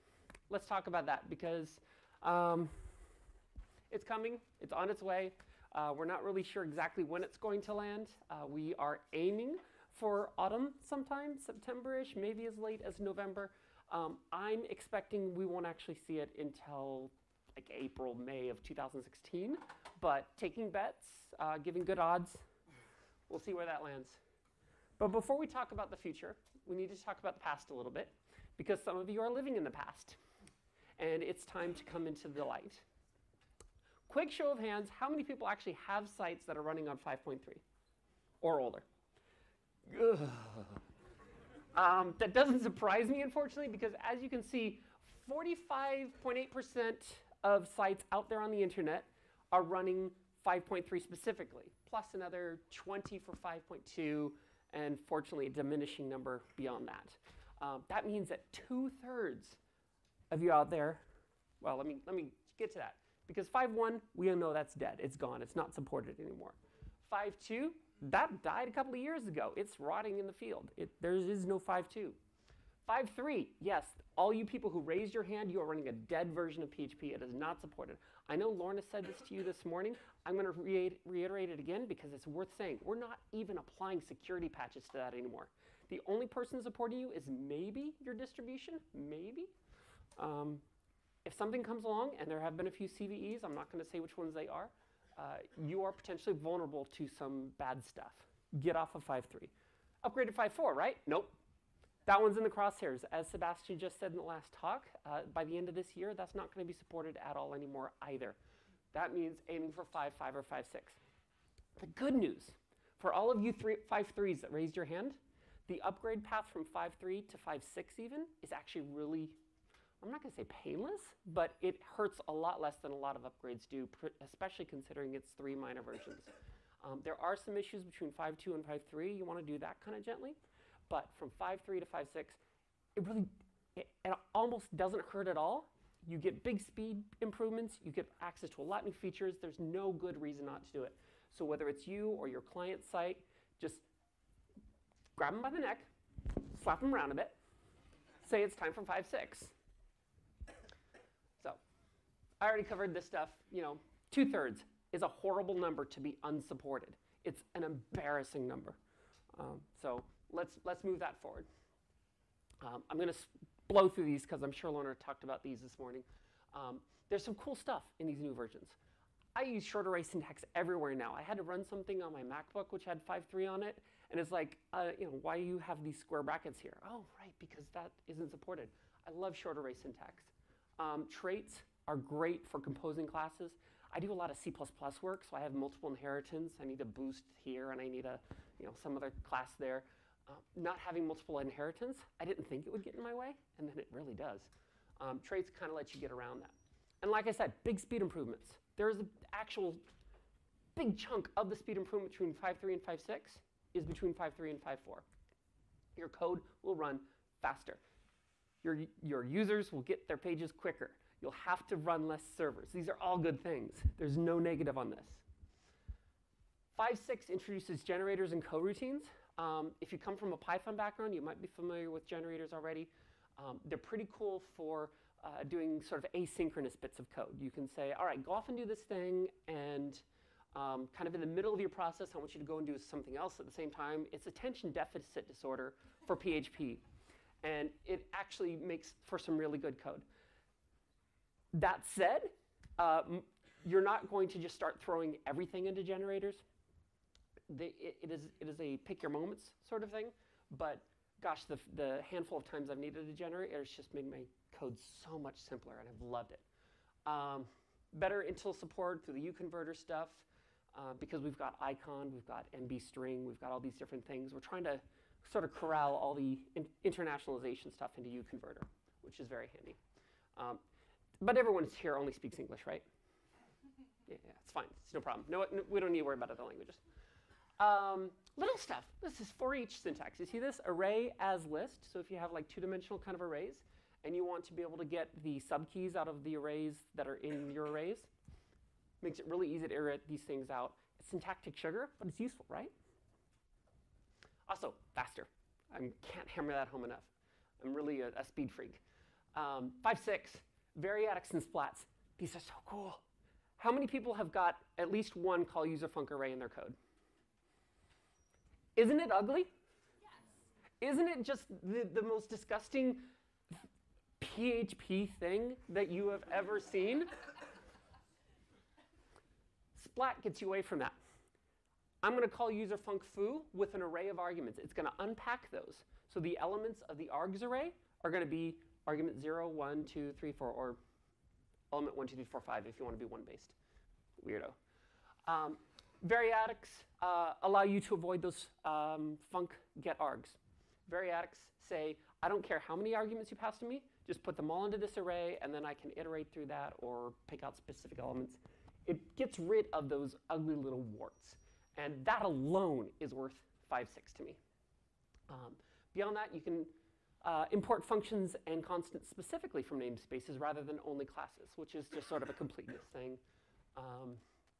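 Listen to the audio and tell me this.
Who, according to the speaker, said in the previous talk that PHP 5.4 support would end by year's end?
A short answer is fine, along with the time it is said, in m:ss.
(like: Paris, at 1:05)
Sebastian, at 1:43.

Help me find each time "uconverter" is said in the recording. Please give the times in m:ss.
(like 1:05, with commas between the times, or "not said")
4:19, 4:28.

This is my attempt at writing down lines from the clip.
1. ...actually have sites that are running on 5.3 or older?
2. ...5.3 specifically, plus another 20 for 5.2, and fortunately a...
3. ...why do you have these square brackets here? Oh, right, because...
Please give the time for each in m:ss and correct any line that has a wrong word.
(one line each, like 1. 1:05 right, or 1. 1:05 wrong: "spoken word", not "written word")
1. 0:35 right
2. 0:50 right
3. 2:55 right.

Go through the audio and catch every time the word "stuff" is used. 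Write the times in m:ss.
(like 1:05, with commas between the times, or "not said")
1:37, 2:33, 2:47, 4:19, 4:27, 4:38.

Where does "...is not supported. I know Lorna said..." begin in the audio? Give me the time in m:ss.
1:17.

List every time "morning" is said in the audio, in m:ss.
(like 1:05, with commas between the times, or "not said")
1:19, 2:45.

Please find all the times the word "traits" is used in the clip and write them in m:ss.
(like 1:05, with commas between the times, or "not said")
3:01, 3:15.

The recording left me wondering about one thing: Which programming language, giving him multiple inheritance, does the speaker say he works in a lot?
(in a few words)
C++.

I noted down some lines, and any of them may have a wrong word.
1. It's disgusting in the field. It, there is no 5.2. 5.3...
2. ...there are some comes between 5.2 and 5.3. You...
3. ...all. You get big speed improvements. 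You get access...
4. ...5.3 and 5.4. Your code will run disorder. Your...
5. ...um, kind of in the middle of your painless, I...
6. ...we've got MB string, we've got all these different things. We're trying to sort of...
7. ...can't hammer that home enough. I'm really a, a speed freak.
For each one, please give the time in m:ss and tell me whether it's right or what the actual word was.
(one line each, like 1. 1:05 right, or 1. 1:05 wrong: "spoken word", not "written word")
1. 1:09 wrong: "rotting", not "disgusting"
2. 2:07 wrong: "issues", not "comes"
3. 2:15 right
4. 3:24 wrong: "faster", not "disorder"
5. 3:50 wrong: "process", not "painless"
6. 4:22 right
7. 4:55 right.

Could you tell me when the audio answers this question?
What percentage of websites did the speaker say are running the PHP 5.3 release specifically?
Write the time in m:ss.
0:45.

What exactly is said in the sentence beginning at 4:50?
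It's syntactic sugar, but it's useful, right?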